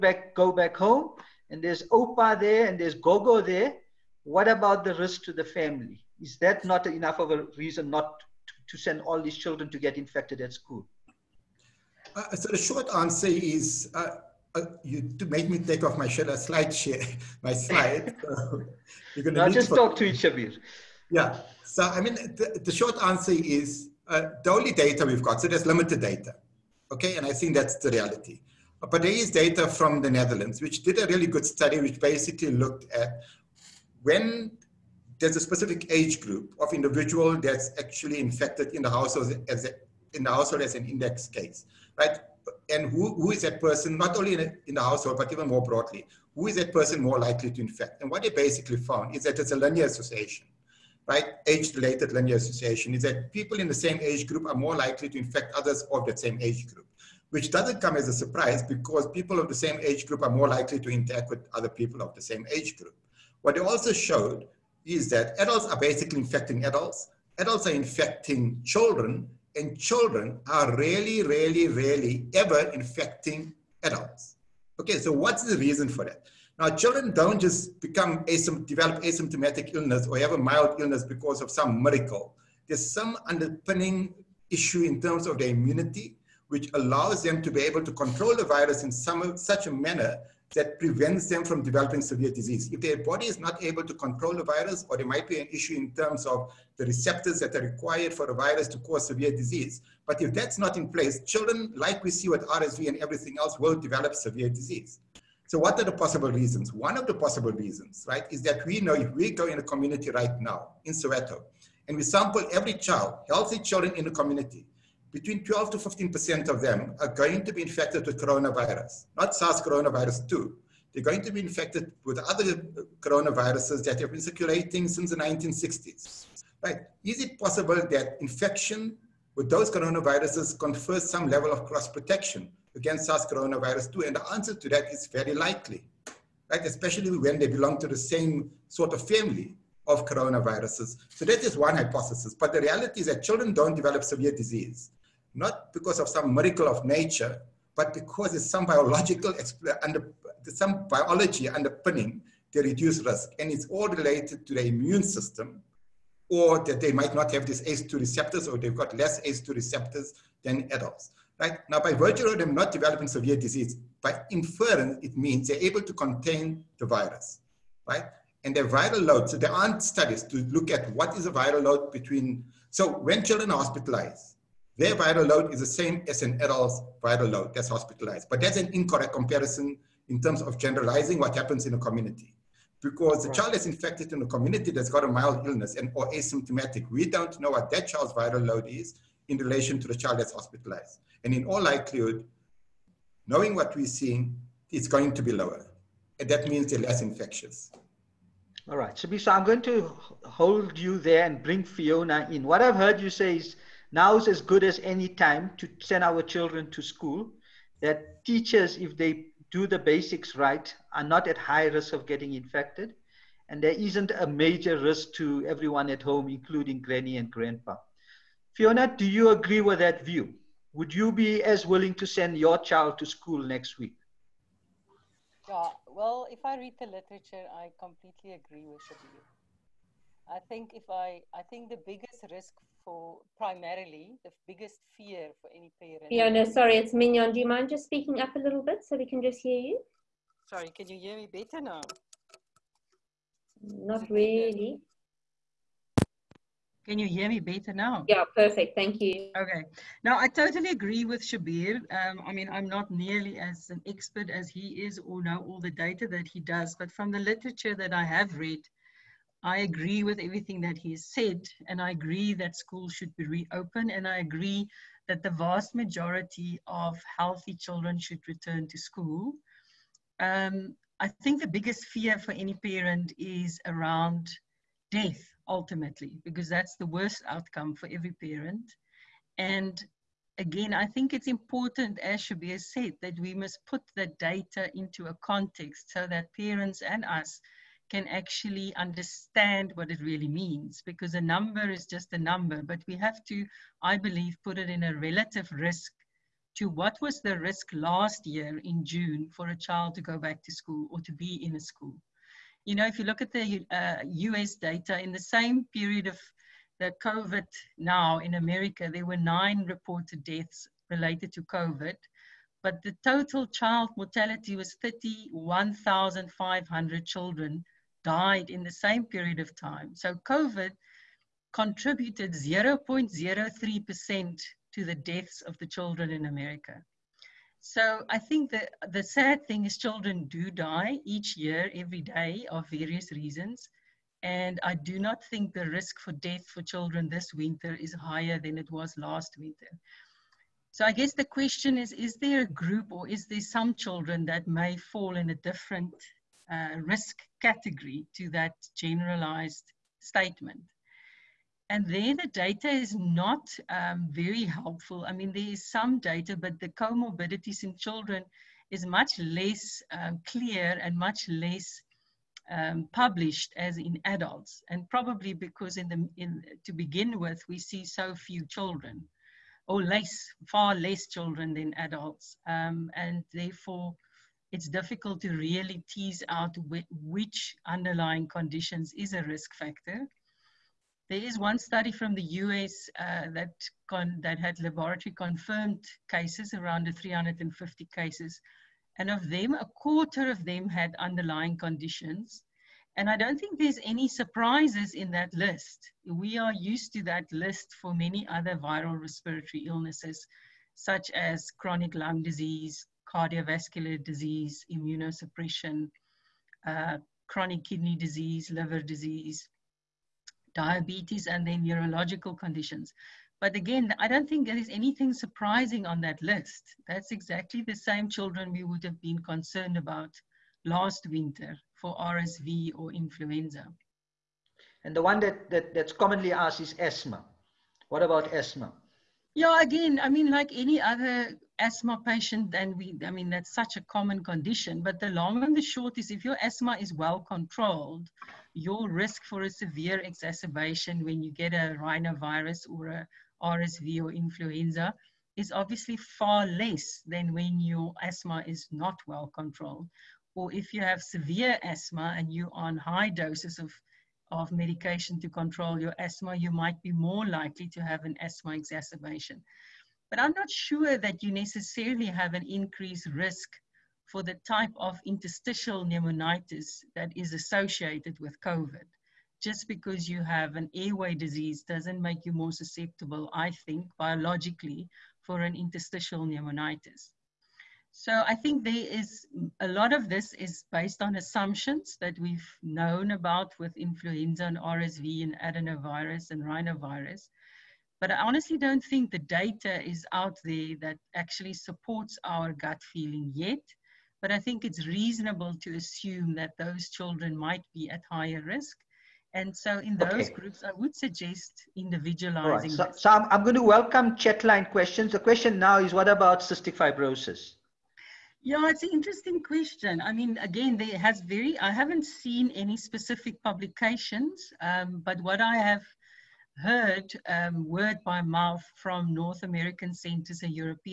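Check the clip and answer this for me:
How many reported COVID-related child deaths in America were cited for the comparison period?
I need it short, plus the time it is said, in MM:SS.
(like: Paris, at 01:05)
9, at 05:09.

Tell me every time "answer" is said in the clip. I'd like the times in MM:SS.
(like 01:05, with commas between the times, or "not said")
00:12, 00:23, 02:14.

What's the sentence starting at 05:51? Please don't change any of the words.
And there the data is not um, very helpful.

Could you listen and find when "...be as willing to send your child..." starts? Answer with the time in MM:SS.
03:41.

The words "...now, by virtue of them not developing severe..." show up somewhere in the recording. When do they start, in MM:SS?
02:41.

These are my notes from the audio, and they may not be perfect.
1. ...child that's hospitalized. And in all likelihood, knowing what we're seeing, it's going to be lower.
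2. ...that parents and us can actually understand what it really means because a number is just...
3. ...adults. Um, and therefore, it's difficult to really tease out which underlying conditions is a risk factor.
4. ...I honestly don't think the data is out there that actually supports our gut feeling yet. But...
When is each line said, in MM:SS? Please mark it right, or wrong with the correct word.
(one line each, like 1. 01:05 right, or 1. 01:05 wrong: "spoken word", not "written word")
1. 03:09 right
2. 04:46 right
3. 06:11 right
4. 08:08 right.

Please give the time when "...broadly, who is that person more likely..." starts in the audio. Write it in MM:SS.
00:45.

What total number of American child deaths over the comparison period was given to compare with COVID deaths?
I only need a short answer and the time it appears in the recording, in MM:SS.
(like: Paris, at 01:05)
31,500, at 05:14.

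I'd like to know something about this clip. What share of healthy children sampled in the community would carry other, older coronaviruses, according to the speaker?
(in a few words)
12 to 15%.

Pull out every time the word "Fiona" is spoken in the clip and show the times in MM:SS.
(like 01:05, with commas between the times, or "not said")
03:21, 03:38, 03:56.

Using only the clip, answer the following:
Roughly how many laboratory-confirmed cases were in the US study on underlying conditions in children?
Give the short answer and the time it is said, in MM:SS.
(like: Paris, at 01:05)
350, at 06:26.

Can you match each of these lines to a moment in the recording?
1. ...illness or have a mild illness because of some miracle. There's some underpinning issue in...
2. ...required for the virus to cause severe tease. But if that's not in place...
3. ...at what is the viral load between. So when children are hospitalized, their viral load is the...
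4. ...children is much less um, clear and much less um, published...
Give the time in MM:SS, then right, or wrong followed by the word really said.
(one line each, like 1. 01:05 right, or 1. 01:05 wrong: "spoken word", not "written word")
1. 01:19 right
2. 01:37 wrong: "disease", not "tease"
3. 02:50 right
4. 05:57 right.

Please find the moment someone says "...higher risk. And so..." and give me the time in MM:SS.
08:18.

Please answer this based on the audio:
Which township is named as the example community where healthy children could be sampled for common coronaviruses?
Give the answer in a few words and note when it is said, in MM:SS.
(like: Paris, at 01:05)
Soweto, at 01:50.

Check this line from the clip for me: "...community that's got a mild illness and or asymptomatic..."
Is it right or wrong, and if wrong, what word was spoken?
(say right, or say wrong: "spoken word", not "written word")
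right.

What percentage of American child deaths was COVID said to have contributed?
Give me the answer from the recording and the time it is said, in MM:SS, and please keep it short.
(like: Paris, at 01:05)
0.03%, at 05:22.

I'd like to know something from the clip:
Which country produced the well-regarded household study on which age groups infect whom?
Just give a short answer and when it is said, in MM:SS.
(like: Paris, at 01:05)
The Netherlands, at 00:30.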